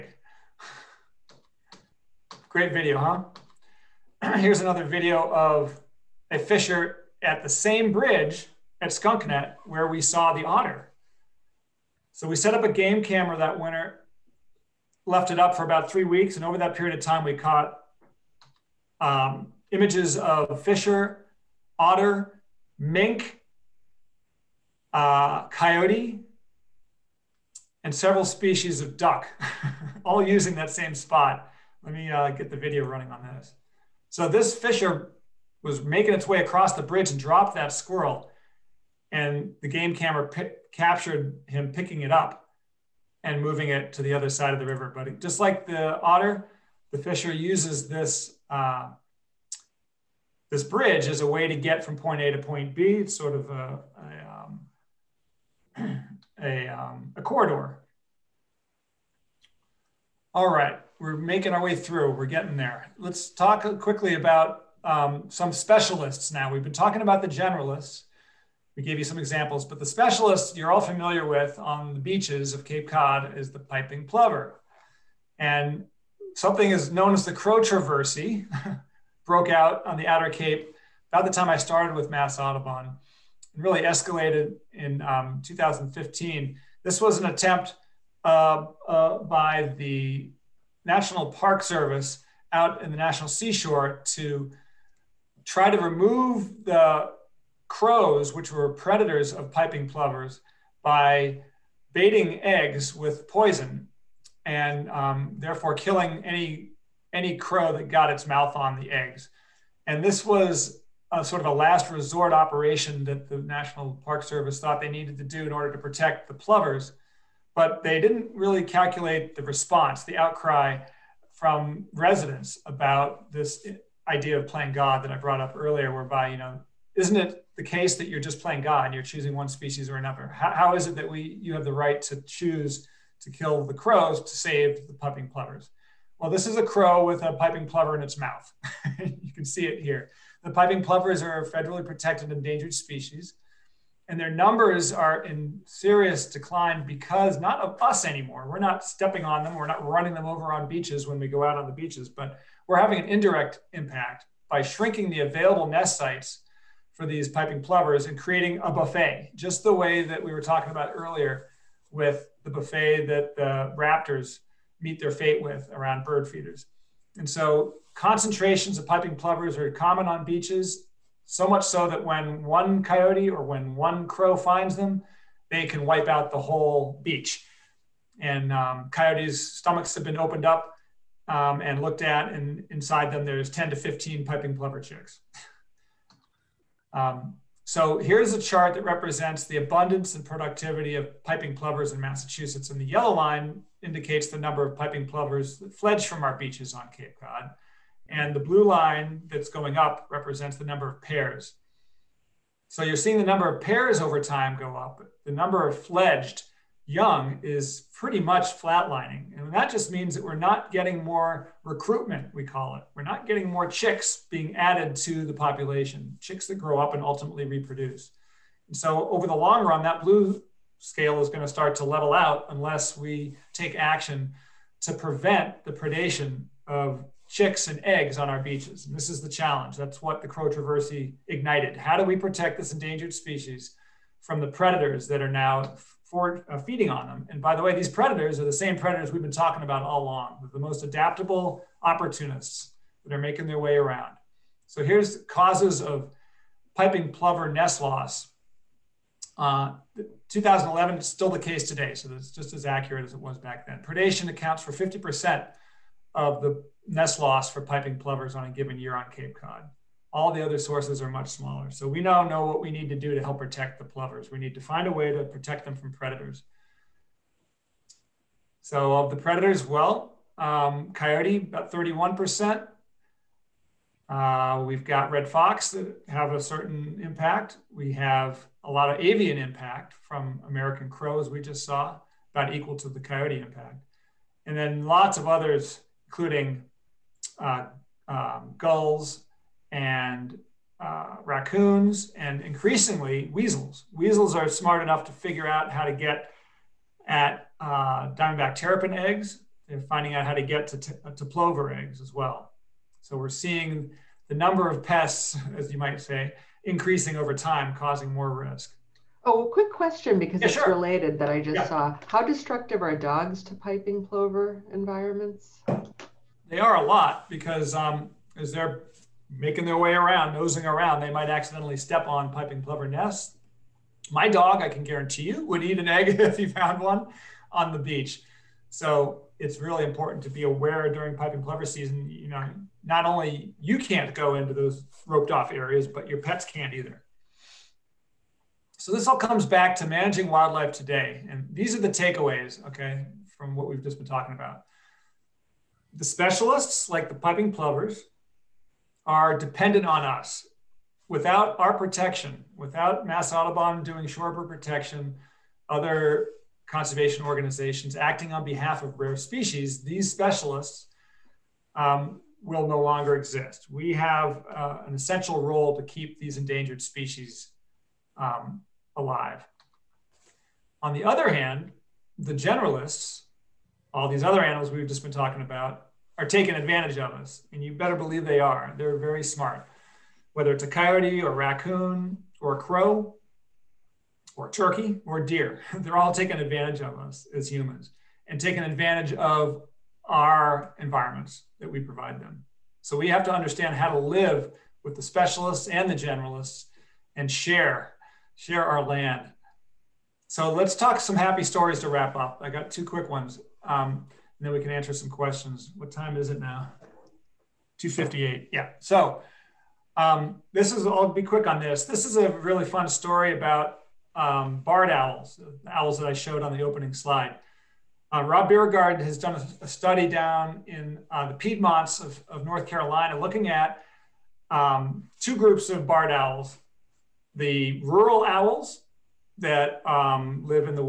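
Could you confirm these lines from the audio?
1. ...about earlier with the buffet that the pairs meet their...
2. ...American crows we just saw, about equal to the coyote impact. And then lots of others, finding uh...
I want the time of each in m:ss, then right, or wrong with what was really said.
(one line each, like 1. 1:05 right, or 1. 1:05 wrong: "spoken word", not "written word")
1. 2:40 wrong: "raptors", not "pairs"
2. 4:40 wrong: "including", not "finding".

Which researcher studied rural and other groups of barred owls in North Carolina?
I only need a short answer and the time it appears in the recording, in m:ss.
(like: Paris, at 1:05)
Rob Bierregaard, at 6:58.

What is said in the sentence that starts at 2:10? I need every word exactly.
how, how is it that we you have the right to choose to kill the crows to save the piping plovers?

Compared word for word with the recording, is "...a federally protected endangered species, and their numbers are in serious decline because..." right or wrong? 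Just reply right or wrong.
right.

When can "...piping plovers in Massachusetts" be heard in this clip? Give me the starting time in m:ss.
3:11.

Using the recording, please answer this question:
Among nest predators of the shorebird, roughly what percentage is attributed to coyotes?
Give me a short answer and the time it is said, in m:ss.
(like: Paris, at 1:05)
About 31%, at 4:31.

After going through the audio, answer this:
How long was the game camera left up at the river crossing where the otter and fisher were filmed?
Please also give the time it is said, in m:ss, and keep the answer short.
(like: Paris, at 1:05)
About 3 weeks, at 0:15.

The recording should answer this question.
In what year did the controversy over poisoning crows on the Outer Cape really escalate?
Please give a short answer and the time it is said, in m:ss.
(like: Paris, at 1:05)
2015, at 1:25.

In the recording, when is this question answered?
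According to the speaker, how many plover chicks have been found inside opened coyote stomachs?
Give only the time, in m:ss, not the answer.
3:03.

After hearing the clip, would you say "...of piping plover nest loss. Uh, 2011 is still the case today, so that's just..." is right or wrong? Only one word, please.
right.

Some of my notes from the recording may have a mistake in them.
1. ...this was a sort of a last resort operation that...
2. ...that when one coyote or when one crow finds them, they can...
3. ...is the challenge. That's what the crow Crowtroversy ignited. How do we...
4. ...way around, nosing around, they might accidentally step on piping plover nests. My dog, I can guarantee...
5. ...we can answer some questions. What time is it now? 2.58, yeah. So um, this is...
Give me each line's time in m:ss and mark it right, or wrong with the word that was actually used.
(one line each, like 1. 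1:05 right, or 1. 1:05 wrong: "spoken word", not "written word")
1. 1:50 right
2. 2:51 right
3. 3:49 right
4. 5:19 right
5. 6:44 right.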